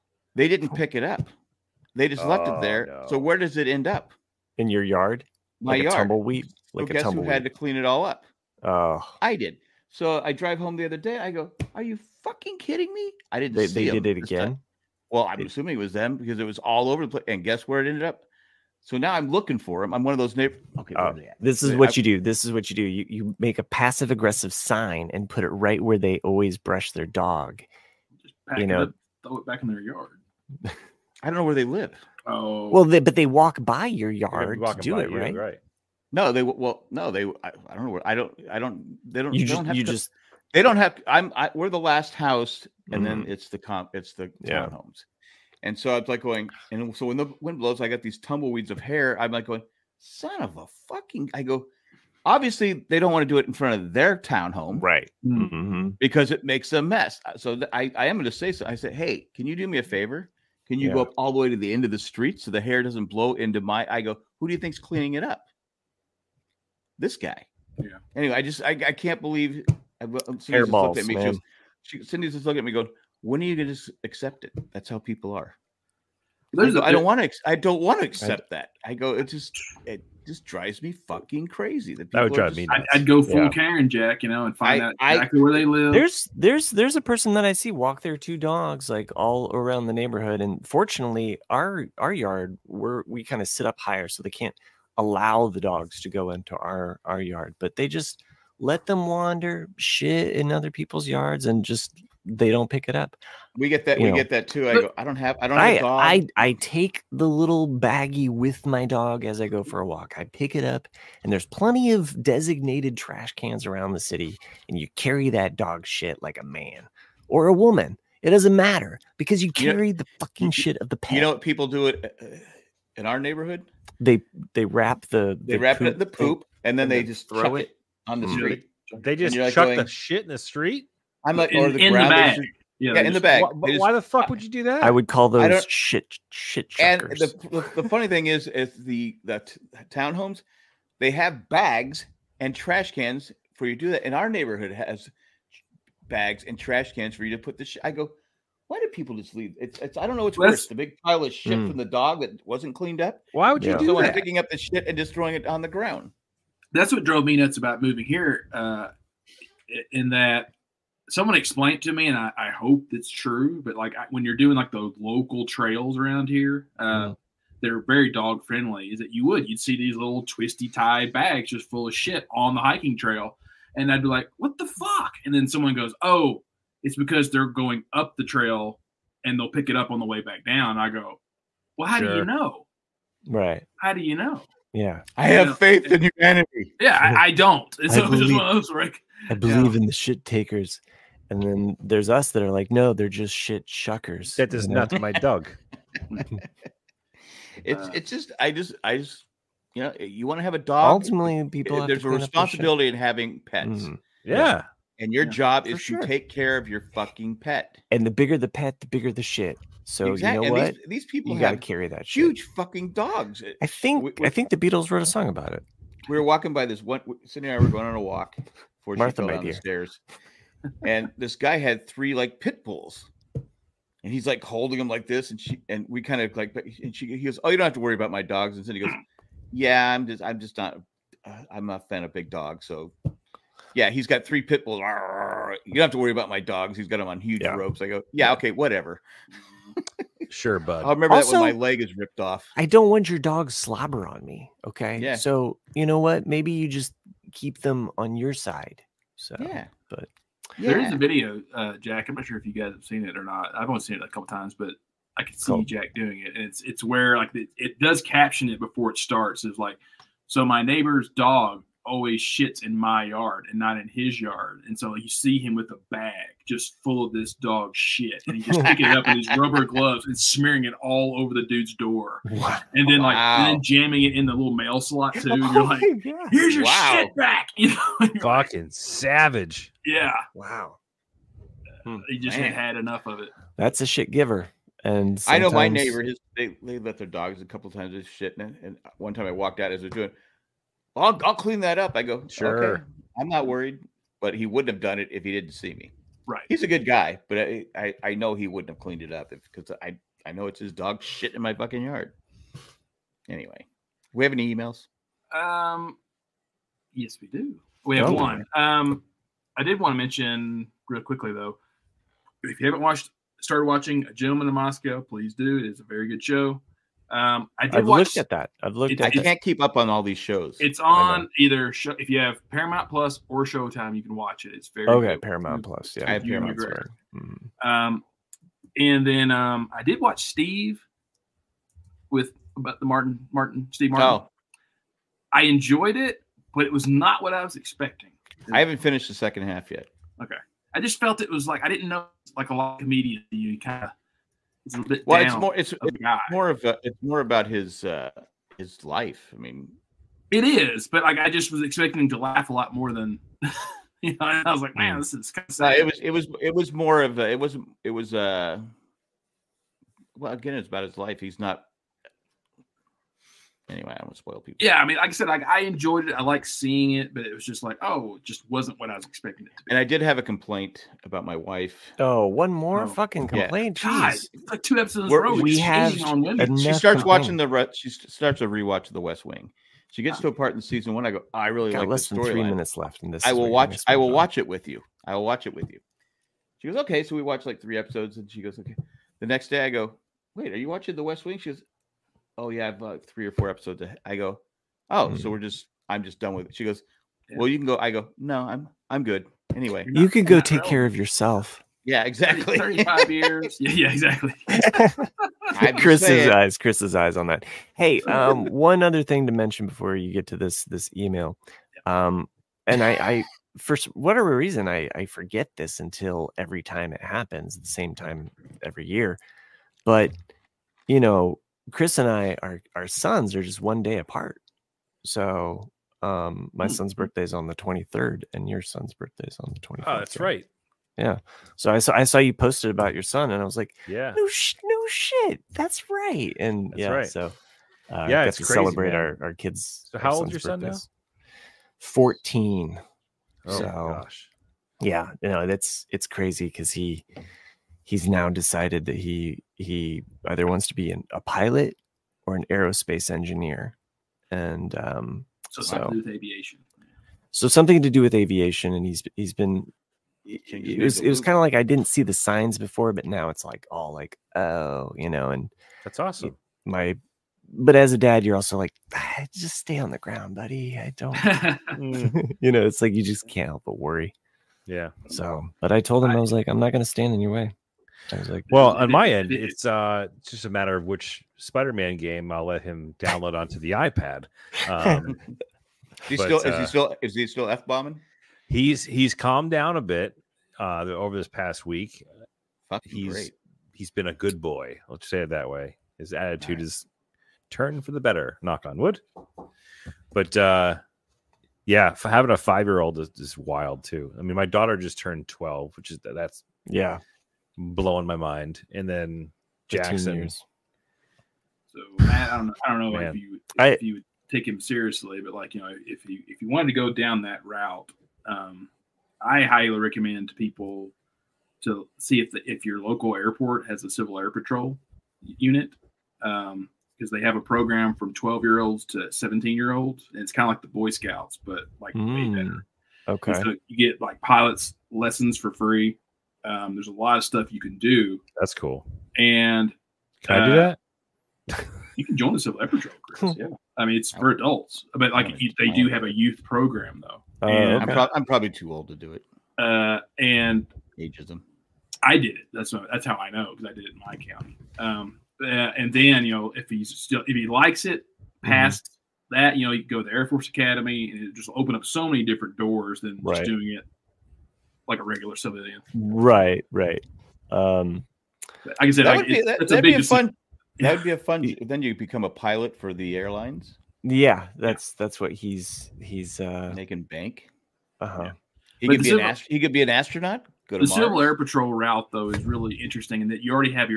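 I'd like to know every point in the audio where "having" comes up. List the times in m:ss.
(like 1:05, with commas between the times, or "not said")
3:22, 8:22.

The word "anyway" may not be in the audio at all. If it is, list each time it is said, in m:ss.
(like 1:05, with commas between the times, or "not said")
1:08, 5:03, 6:03, 6:39.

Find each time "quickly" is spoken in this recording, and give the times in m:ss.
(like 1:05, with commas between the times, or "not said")
5:11.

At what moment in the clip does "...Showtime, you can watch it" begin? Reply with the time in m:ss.
5:23.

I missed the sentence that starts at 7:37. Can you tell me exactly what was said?
So something to do with aviation, and he's he's been.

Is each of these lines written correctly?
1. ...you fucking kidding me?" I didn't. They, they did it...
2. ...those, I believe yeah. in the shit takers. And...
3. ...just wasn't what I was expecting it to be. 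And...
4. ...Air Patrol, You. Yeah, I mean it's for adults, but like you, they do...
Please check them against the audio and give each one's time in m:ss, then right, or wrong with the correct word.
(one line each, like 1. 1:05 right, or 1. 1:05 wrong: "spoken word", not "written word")
1. 0:11 right
2. 3:08 right
3. 6:08 right
4. 9:02 wrong: "Chris", not "You".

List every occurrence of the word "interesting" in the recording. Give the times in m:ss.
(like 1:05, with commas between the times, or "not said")
9:42.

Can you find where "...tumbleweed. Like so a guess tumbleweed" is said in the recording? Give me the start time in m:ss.
0:05.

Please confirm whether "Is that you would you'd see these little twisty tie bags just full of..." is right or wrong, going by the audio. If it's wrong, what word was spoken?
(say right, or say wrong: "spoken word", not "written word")
right.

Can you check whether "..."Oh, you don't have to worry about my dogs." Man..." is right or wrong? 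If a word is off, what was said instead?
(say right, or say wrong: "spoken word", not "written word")
wrong: "And", not "Man".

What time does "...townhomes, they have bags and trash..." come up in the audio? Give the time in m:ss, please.
2:19.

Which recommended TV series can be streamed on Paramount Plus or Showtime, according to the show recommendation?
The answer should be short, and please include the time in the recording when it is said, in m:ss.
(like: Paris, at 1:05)
A Gentleman in Moscow, at 5:14.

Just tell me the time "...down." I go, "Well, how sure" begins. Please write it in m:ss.
3:00.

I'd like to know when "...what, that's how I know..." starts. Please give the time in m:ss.
9:12.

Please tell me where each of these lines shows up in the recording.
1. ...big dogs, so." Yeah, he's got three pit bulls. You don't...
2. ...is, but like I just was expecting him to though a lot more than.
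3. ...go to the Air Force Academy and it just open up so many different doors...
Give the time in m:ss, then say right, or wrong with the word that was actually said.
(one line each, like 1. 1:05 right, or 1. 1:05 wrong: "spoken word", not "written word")
1. 3:52 right
2. 5:50 wrong: "laugh", not "though"
3. 9:19 right.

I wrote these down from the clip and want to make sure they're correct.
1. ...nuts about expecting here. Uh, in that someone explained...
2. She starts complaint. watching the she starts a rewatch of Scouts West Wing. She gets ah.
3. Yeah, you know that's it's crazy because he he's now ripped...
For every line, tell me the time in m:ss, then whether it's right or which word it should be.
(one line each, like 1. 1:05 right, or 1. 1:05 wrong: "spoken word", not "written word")
1. 2:37 wrong: "moving", not "expecting"
2. 6:16 wrong: "The", not "Scouts"
3. 7:24 wrong: "decided", not "ripped".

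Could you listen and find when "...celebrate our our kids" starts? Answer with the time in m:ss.
7:18.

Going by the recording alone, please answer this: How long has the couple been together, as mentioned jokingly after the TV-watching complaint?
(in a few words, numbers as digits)
35 years.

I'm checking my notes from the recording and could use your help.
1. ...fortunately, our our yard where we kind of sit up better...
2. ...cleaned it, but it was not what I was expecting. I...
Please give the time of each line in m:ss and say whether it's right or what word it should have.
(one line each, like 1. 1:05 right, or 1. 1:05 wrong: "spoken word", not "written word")
1. 1:30 wrong: "higher", not "better"
2. 5:35 wrong: "enjoyed", not "cleaned".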